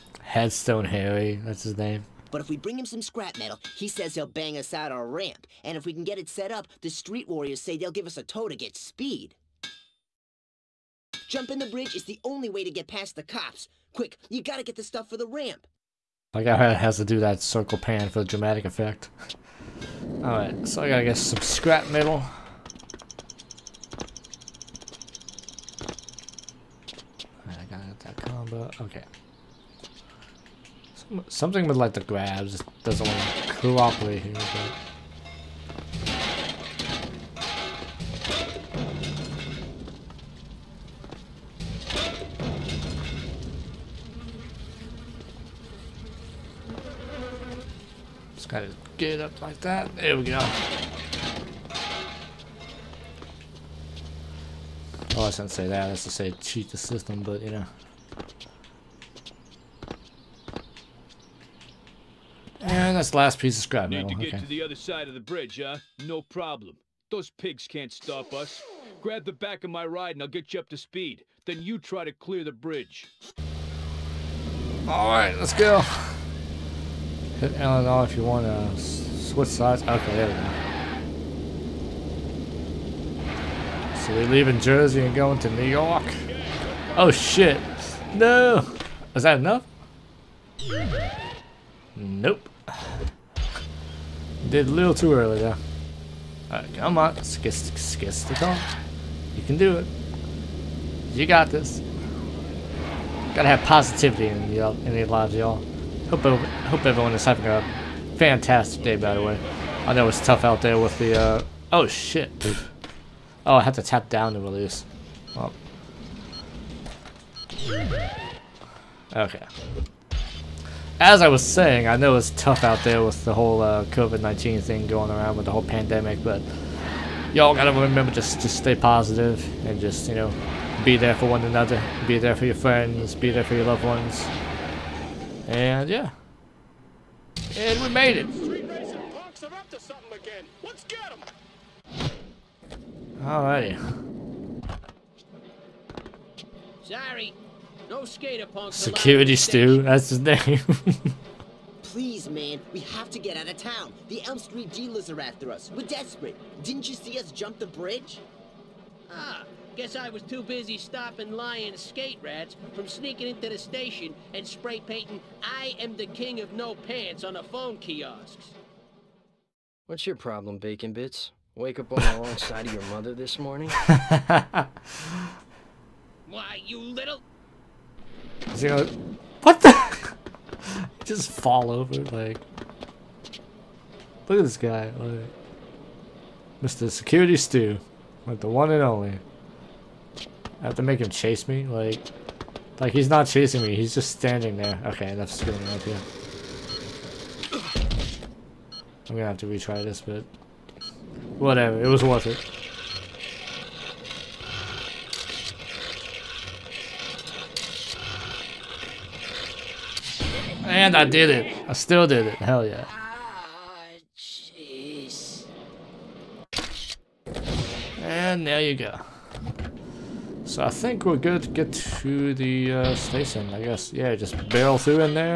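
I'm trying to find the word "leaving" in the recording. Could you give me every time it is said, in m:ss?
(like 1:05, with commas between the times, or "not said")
1:24.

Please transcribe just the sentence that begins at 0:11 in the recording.
Jumping the bridge is the only way to get past the cops.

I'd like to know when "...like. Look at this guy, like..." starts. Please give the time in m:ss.
3:02.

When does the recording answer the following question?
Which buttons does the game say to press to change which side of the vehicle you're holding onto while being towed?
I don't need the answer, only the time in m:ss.
1:17.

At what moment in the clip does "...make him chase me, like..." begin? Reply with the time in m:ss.
3:10.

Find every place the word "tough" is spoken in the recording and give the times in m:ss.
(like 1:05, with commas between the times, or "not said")
1:50, 2:02.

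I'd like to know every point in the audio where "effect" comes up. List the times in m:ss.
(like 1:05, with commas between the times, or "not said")
0:18.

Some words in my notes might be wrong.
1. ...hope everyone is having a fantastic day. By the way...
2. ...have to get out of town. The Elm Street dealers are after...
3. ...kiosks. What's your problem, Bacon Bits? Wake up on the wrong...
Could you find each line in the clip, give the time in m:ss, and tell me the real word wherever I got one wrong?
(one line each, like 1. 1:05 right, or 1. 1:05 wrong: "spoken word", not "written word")
1. 1:46 right
2. 2:32 right
3. 2:47 right.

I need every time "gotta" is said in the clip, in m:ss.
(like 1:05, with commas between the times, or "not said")
0:14, 0:20, 0:48, 1:43, 2:07.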